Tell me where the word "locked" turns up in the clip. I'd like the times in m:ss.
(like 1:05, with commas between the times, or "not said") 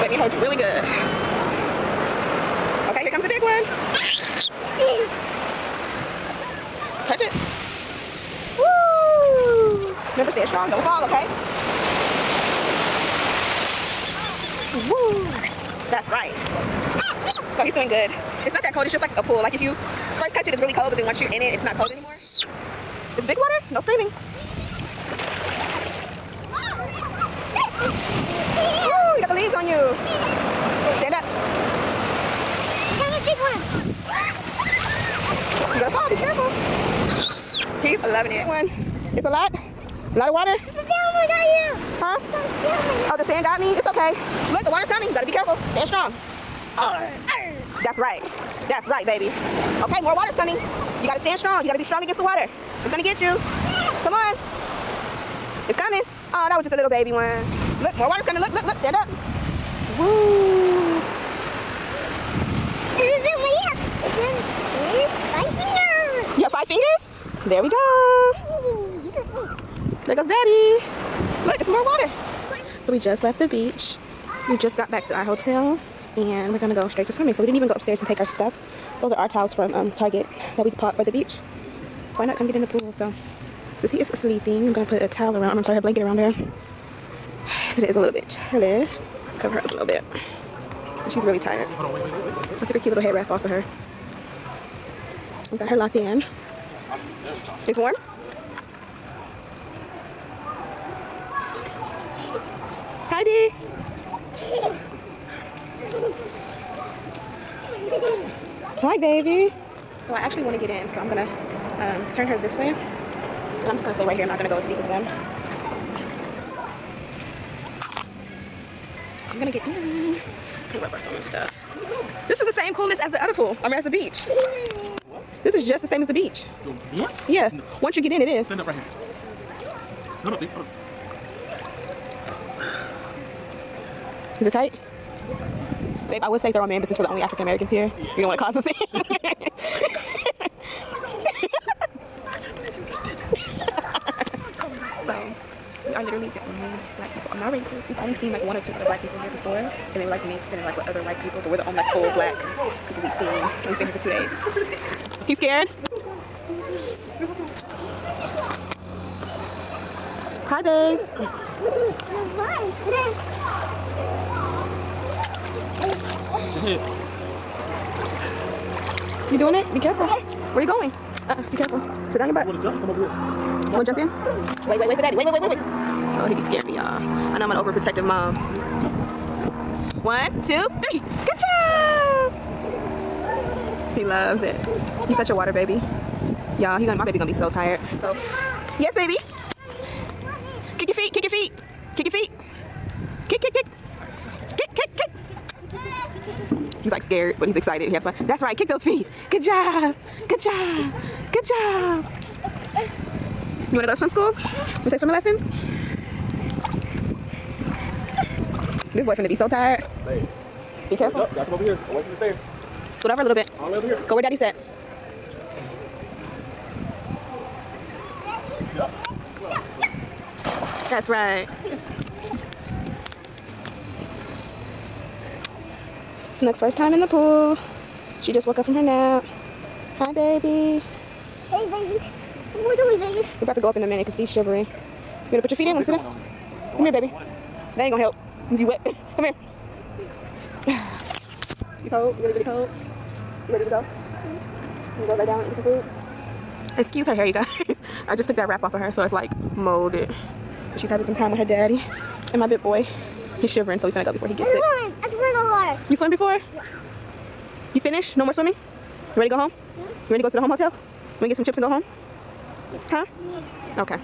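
1:35.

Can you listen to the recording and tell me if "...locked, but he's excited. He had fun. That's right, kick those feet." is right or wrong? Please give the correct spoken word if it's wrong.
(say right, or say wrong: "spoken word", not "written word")
wrong: "scared", not "locked".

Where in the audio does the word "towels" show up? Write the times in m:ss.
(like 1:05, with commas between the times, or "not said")
1:19, 1:25.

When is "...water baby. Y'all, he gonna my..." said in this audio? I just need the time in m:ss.
3:05.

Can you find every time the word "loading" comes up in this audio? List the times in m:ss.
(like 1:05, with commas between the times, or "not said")
not said.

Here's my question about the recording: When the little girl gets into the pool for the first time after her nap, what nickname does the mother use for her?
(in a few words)
Snook.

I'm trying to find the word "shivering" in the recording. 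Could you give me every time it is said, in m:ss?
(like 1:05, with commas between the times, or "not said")
3:54, 4:13.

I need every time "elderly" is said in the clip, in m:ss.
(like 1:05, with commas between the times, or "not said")
not said.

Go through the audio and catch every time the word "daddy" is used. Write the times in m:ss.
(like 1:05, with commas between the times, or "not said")
1:10, 1:43, 2:55, 3:34, 4:11.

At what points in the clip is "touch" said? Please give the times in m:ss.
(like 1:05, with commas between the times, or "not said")
0:07, 0:20.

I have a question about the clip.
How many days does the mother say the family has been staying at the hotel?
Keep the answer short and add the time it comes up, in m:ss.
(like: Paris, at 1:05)
2, at 2:33.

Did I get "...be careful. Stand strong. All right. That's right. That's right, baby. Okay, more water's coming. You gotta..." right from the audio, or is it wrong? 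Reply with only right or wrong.
right.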